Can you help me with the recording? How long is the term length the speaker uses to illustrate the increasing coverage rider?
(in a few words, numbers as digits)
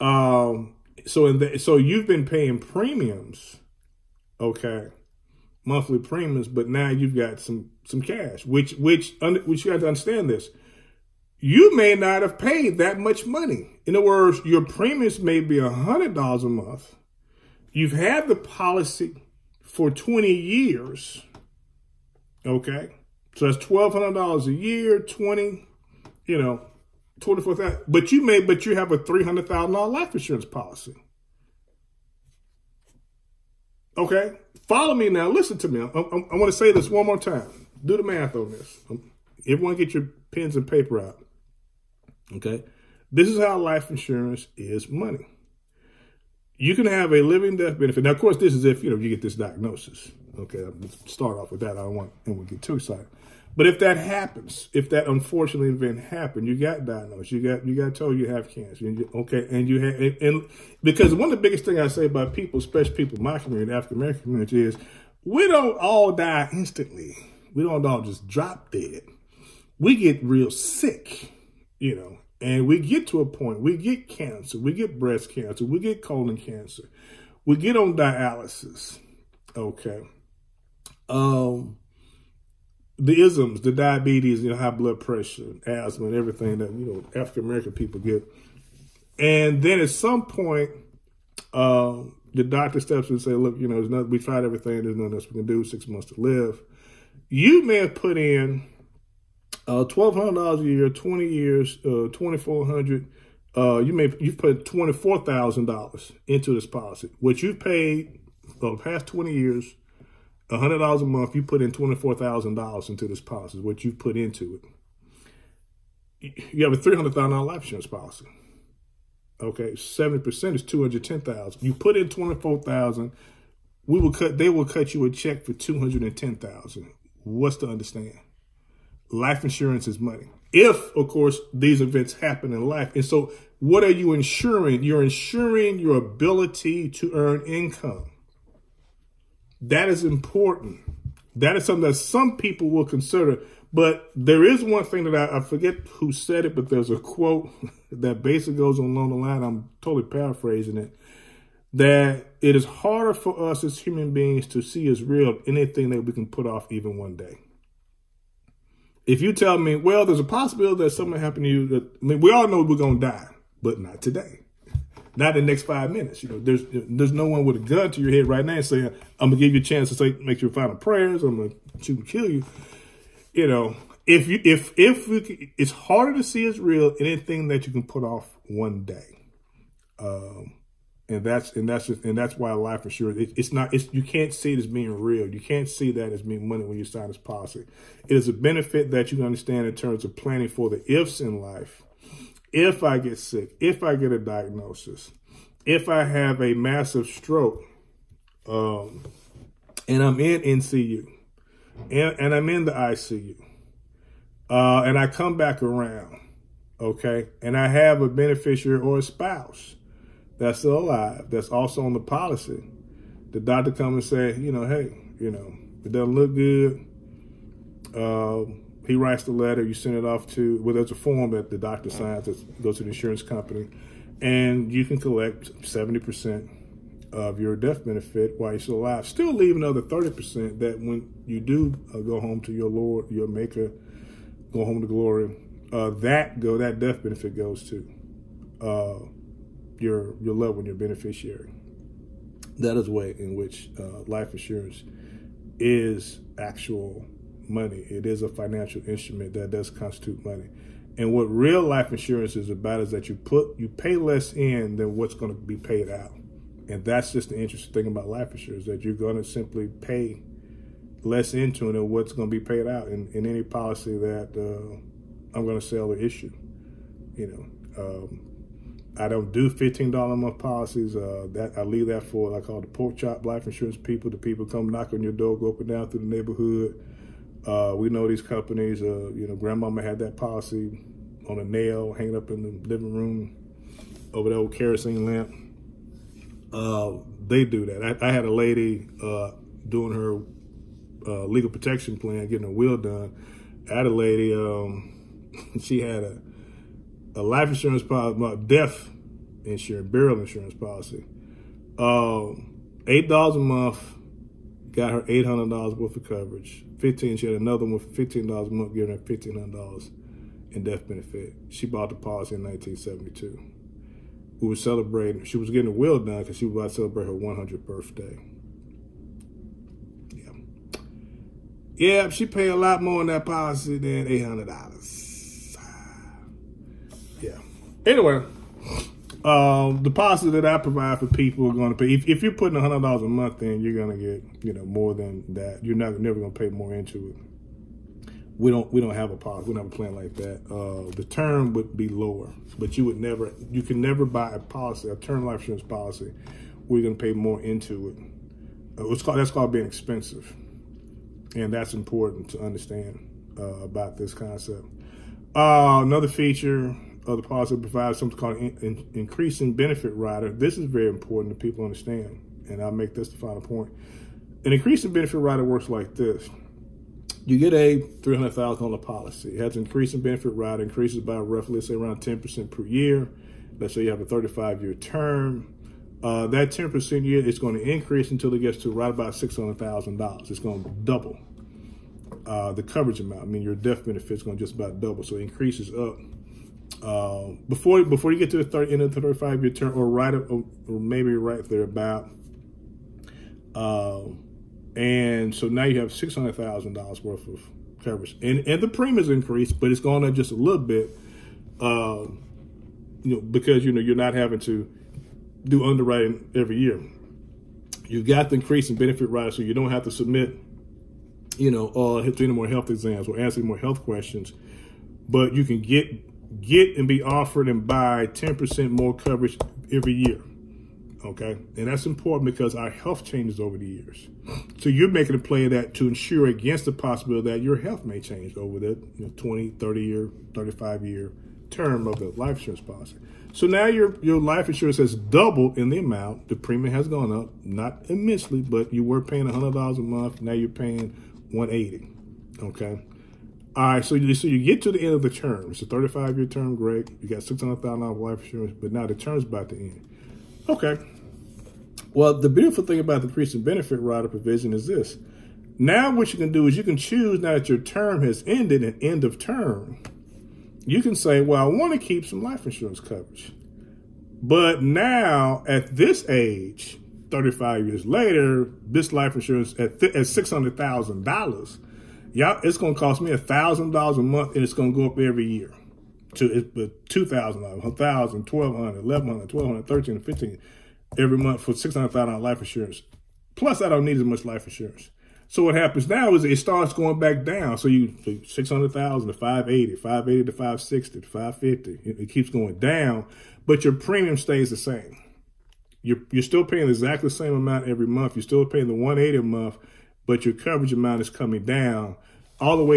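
35 years.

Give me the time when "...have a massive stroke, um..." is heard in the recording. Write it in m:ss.
3:16.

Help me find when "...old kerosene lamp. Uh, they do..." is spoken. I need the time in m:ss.
4:44.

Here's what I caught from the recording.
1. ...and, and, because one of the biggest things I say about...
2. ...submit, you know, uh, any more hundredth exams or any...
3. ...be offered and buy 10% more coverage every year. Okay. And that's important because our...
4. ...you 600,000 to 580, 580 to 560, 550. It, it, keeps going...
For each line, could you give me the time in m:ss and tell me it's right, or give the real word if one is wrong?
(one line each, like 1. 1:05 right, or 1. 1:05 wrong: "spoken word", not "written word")
1. 0:59 right
2. 6:49 wrong: "health", not "hundredth"
3. 6:56 right
4. 8:07 right.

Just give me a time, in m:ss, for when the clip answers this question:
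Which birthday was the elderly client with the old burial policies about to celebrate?
5:17.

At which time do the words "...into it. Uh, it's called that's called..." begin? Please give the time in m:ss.
5:47.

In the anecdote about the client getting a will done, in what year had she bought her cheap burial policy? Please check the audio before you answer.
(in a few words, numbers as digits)
1972.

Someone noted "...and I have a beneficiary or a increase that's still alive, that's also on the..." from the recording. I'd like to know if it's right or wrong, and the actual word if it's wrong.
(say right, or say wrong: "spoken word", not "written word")
wrong: "spouse", not "increase".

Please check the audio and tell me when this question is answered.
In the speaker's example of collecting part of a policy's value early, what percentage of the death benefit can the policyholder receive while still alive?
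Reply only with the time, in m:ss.
3:45.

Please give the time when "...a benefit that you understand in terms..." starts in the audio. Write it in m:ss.
3:08.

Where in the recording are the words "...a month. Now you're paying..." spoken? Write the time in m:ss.
7:19.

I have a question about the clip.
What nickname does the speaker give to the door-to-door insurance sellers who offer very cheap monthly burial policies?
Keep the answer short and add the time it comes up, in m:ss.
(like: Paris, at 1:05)
pork chop life insurance people, at 4:32.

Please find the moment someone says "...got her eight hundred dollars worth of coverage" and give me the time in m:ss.
5:04.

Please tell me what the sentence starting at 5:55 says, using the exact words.
Uh, another feature other policy provides something called in, in, increasing benefit rider.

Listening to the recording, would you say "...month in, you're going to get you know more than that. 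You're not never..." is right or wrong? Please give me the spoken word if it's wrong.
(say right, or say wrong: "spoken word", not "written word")
right.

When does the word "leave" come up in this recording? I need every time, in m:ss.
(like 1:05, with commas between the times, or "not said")
3:49, 4:31.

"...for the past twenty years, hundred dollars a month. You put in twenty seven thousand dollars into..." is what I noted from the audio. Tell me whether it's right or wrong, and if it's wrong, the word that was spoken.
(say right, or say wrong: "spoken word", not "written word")
wrong: "four", not "seven".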